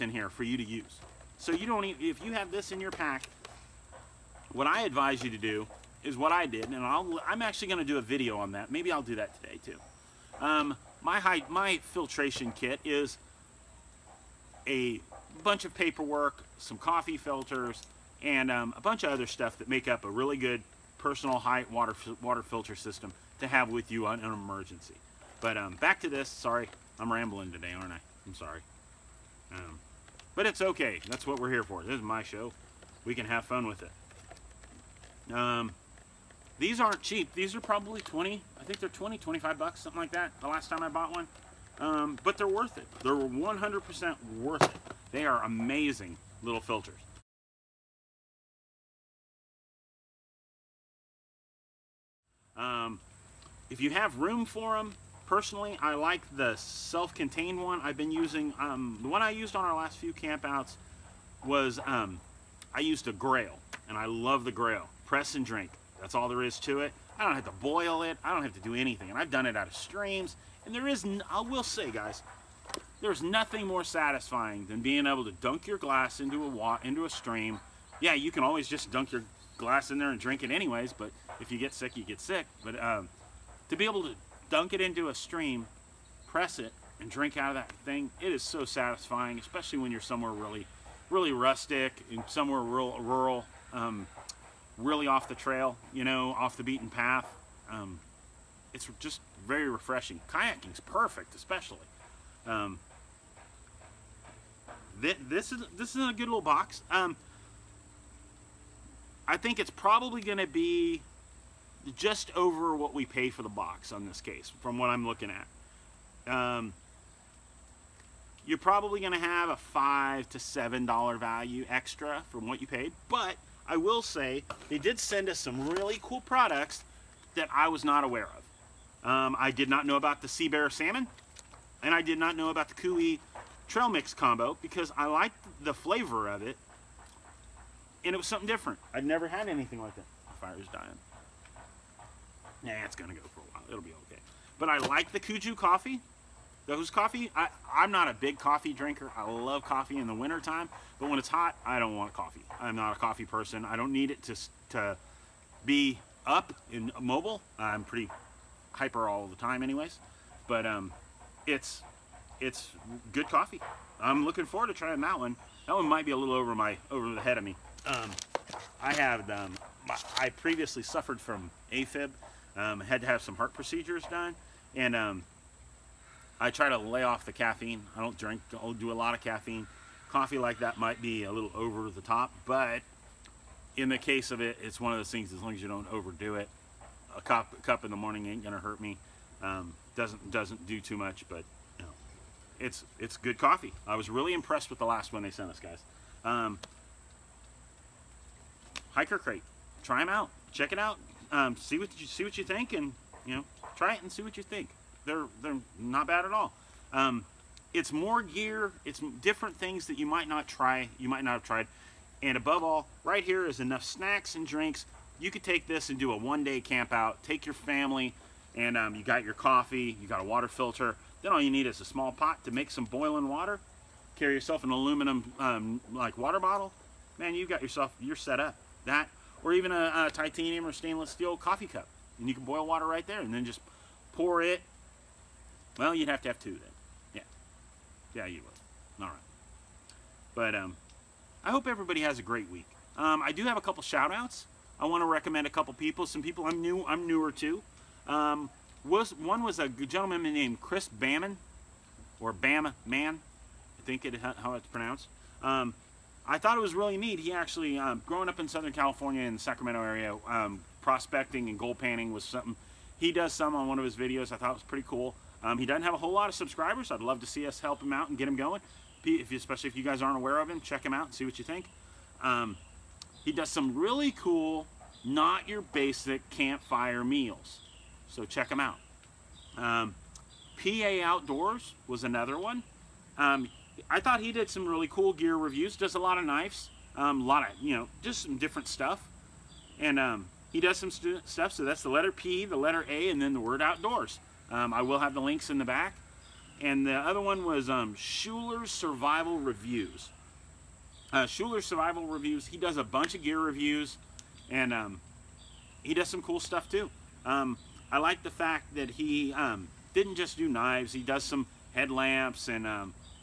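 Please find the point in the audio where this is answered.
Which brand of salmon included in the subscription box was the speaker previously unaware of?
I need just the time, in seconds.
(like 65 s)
130 s.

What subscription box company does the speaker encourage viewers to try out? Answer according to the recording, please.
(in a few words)
Hiker Crate.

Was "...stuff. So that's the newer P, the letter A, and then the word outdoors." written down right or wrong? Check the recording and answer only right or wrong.
wrong.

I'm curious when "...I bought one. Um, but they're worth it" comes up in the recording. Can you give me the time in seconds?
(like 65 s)
40 s.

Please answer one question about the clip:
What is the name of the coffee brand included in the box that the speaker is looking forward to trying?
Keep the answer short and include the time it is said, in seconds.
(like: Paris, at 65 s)
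Kuju, at 145 s.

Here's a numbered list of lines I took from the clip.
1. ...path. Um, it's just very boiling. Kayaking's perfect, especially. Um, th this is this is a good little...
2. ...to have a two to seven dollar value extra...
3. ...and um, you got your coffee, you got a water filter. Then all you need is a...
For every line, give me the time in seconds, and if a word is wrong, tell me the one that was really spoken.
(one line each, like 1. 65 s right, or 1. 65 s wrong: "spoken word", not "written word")
1. 96 s wrong: "refreshing", not "boiling"
2. 119 s wrong: "five", not "two"
3. 218 s right.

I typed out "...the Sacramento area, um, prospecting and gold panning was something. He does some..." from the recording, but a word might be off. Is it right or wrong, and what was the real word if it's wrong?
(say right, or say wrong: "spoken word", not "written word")
right.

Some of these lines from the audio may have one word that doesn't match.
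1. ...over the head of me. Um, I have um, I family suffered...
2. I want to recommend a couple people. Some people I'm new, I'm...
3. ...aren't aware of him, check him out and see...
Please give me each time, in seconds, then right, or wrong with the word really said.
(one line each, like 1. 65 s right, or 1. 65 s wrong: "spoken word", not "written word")
1. 166 s wrong: "previously", not "family"
2. 244 s right
3. 270 s right.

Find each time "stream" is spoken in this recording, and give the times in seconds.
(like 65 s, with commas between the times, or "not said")
69 s, 77 s, 85 s.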